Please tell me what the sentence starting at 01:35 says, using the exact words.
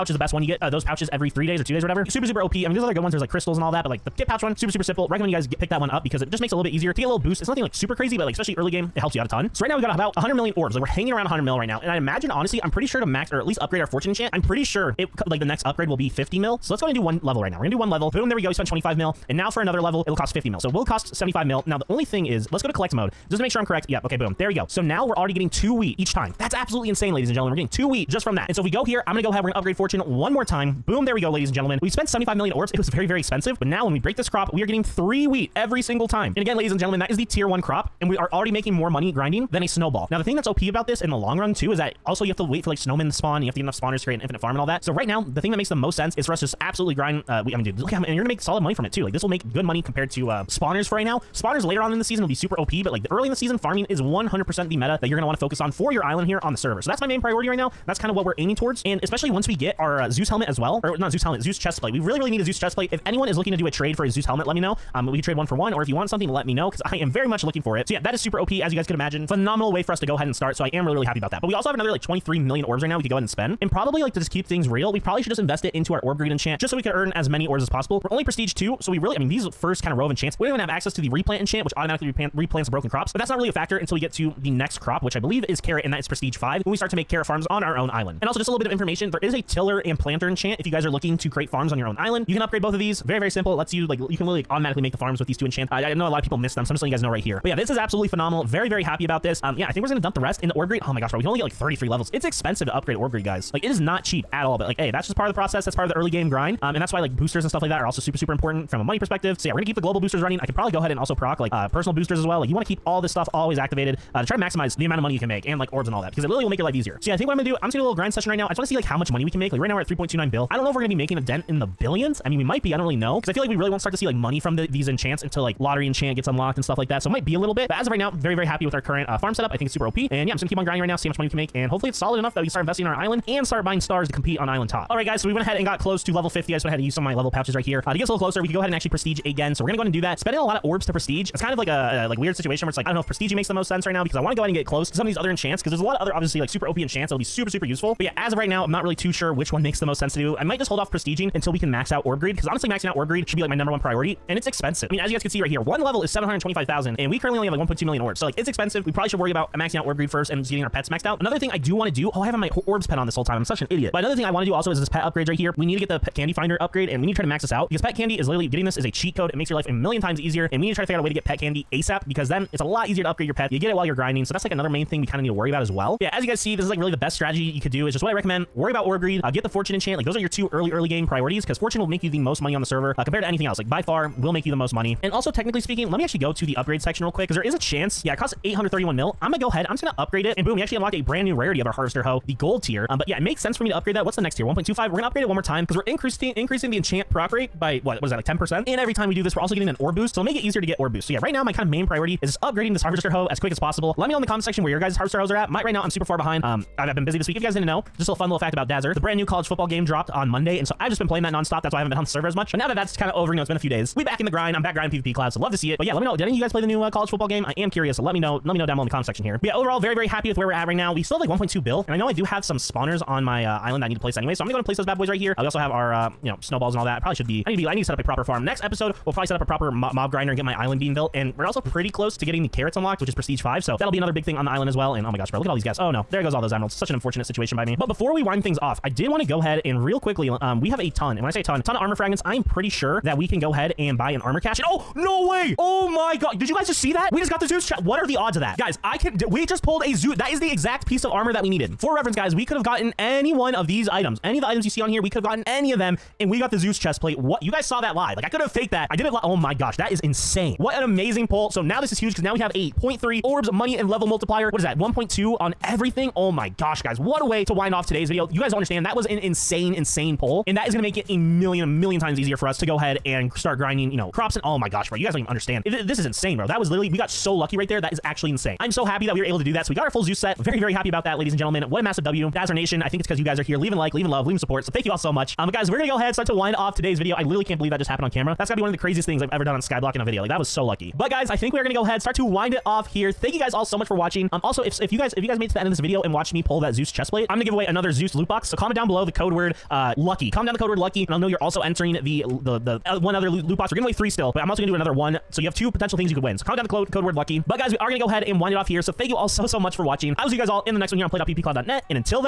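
I, I know a lot of people miss them, so I'm just letting you guys know right here.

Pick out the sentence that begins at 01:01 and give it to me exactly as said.
We really, really need a Zeus chest plate.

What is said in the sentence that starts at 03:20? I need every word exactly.
So it'll make it easier to get orb boost.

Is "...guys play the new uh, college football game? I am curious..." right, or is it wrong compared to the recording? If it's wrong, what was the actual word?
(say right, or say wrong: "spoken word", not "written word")
right.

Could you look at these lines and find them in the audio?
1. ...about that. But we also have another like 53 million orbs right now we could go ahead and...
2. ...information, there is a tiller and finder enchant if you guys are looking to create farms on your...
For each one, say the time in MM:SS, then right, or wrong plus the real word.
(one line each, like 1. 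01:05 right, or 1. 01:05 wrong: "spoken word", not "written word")
1. 01:11 wrong: "23", not "53"
2. 01:28 wrong: "planter", not "finder".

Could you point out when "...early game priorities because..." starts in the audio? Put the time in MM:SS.
03:00.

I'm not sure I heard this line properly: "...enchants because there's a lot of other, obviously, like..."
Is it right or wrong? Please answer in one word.
right.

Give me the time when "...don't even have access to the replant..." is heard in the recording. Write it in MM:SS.
01:20.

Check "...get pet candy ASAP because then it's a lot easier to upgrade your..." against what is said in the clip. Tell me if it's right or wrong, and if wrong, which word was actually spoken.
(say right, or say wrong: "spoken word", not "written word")
right.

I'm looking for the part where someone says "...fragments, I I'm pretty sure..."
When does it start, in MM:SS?
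04:01.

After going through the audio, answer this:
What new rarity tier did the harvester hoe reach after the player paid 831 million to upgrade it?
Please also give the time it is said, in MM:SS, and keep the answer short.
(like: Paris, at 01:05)
Gold tier, at 03:12.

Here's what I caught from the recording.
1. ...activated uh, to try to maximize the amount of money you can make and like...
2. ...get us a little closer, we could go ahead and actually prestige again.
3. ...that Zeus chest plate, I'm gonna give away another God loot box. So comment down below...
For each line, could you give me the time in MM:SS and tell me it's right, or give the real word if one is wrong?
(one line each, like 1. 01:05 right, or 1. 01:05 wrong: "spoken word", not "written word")
1. 01:53 right
2. 02:17 right
3. 04:56 wrong: "Zeus", not "God".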